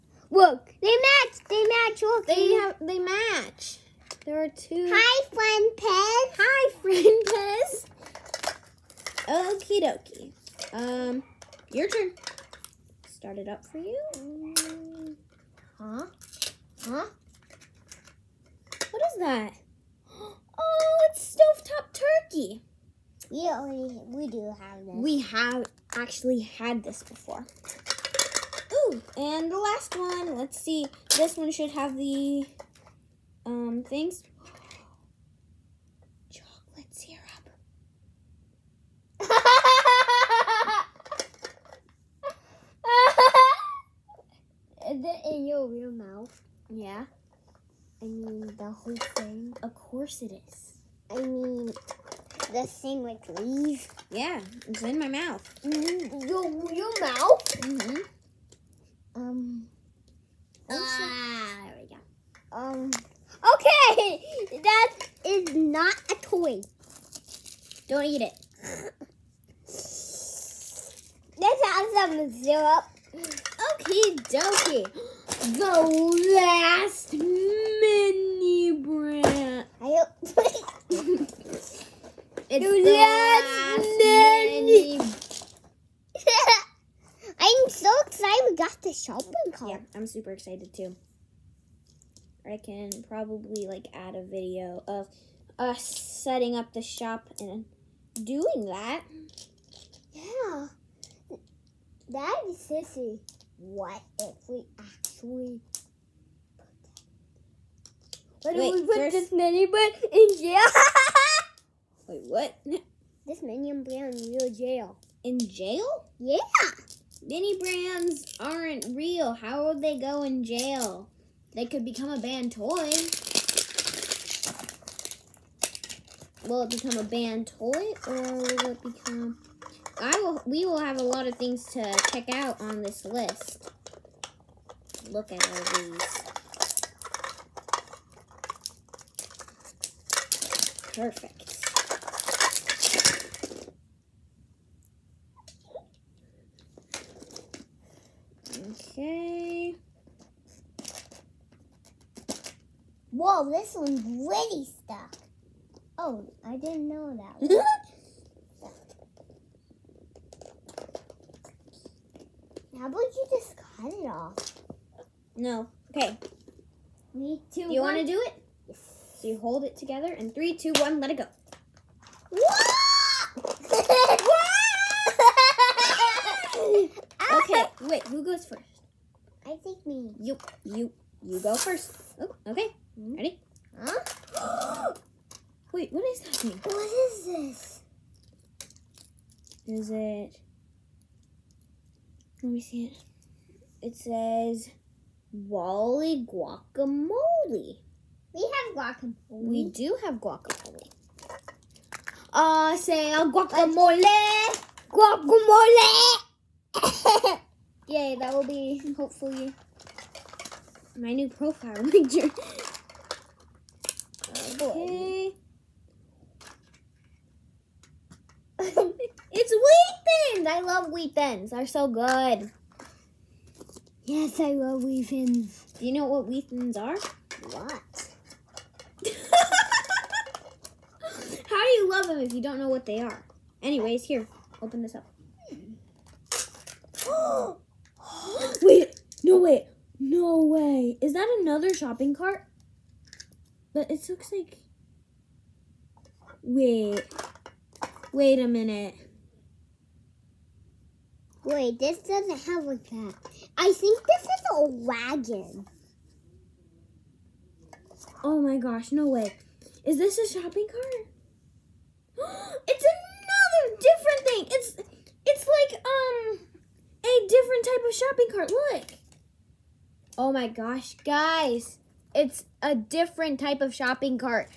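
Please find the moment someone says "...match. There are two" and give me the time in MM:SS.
00:02.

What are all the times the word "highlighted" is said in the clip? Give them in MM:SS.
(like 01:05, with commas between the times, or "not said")
not said.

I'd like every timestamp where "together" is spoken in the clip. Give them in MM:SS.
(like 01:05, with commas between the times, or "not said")
02:49.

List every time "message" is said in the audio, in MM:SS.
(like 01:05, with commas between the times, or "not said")
not said.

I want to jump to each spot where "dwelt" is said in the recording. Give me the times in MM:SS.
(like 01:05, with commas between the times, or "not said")
not said.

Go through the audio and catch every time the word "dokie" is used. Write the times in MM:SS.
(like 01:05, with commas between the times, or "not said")
00:09, 01:14.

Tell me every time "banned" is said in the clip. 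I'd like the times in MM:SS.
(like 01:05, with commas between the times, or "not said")
02:02, 02:07.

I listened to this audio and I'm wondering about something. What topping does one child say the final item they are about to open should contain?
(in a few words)
Chocolate syrup.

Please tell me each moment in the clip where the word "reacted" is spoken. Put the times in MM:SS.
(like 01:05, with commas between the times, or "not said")
not said.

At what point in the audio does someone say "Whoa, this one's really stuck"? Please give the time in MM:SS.
02:33.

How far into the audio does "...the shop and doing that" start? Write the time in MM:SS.
01:36.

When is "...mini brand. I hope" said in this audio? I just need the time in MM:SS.
01:17.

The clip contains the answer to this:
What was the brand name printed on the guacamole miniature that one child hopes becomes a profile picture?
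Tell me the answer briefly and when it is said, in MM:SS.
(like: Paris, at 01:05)
Wally, at 03:15.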